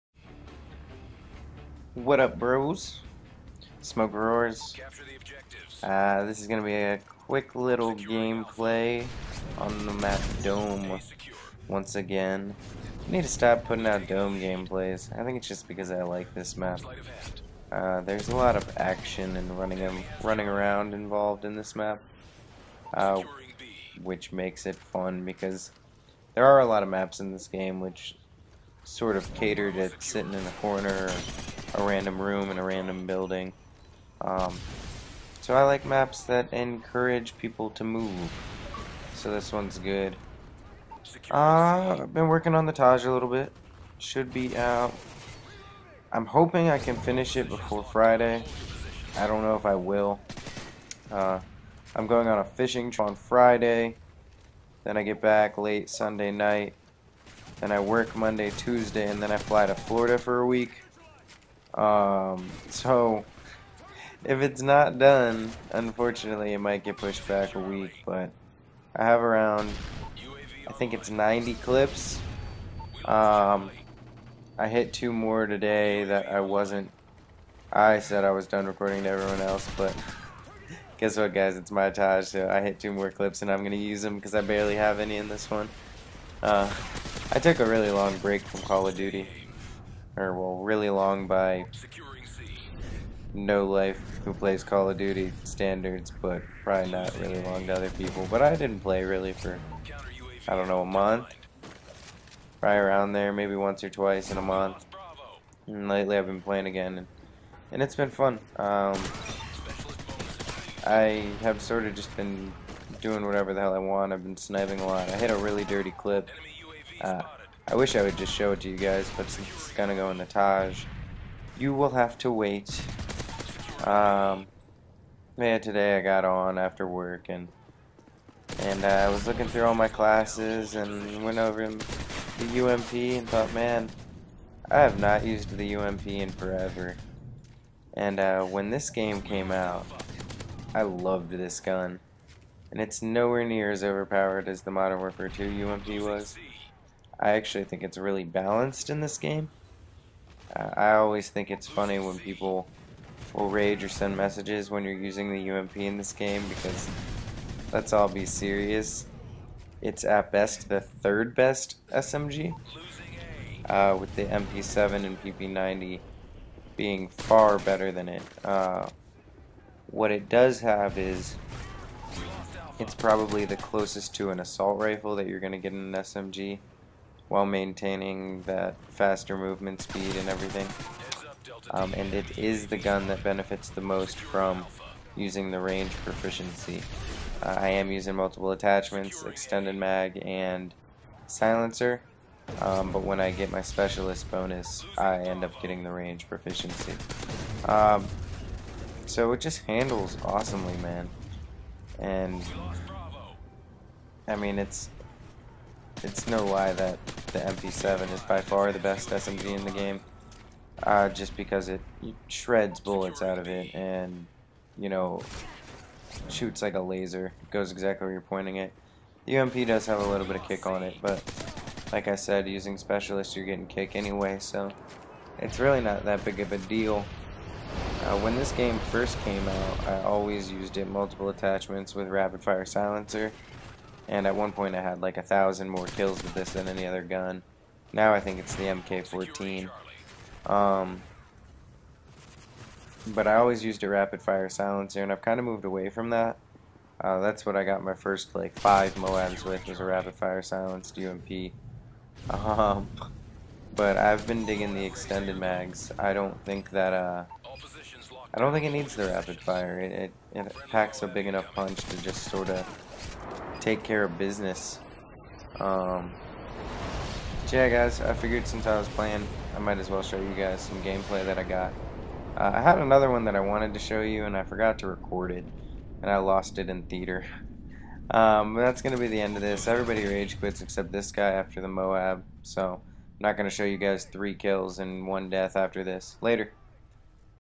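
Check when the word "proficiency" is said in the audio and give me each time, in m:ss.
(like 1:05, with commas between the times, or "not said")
3:06, 3:16.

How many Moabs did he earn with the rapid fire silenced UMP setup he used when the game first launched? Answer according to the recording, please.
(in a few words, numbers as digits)
5.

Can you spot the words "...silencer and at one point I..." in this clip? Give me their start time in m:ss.
3:52.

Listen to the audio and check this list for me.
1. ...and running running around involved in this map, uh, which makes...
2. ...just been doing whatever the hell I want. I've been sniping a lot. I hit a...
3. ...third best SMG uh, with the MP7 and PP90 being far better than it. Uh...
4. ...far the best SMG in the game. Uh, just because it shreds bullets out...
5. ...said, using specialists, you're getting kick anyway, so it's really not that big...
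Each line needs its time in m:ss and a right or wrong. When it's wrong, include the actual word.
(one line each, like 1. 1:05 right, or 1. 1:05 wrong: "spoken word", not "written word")
1. 0:19 right
2. 1:51 right
3. 2:40 right
4. 3:28 right
5. 3:42 right.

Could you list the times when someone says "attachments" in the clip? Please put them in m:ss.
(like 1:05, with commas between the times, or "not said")
3:08, 3:51.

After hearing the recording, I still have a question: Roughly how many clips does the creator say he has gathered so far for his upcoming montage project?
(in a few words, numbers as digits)
90.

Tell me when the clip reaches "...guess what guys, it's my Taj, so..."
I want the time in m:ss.
1:20.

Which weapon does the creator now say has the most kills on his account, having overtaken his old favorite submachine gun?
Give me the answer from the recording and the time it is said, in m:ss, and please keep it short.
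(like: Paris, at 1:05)
MK14, at 3:58.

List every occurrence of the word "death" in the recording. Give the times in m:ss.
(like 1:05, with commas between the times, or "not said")
4:45.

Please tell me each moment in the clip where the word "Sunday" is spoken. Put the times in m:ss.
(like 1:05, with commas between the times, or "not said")
0:55.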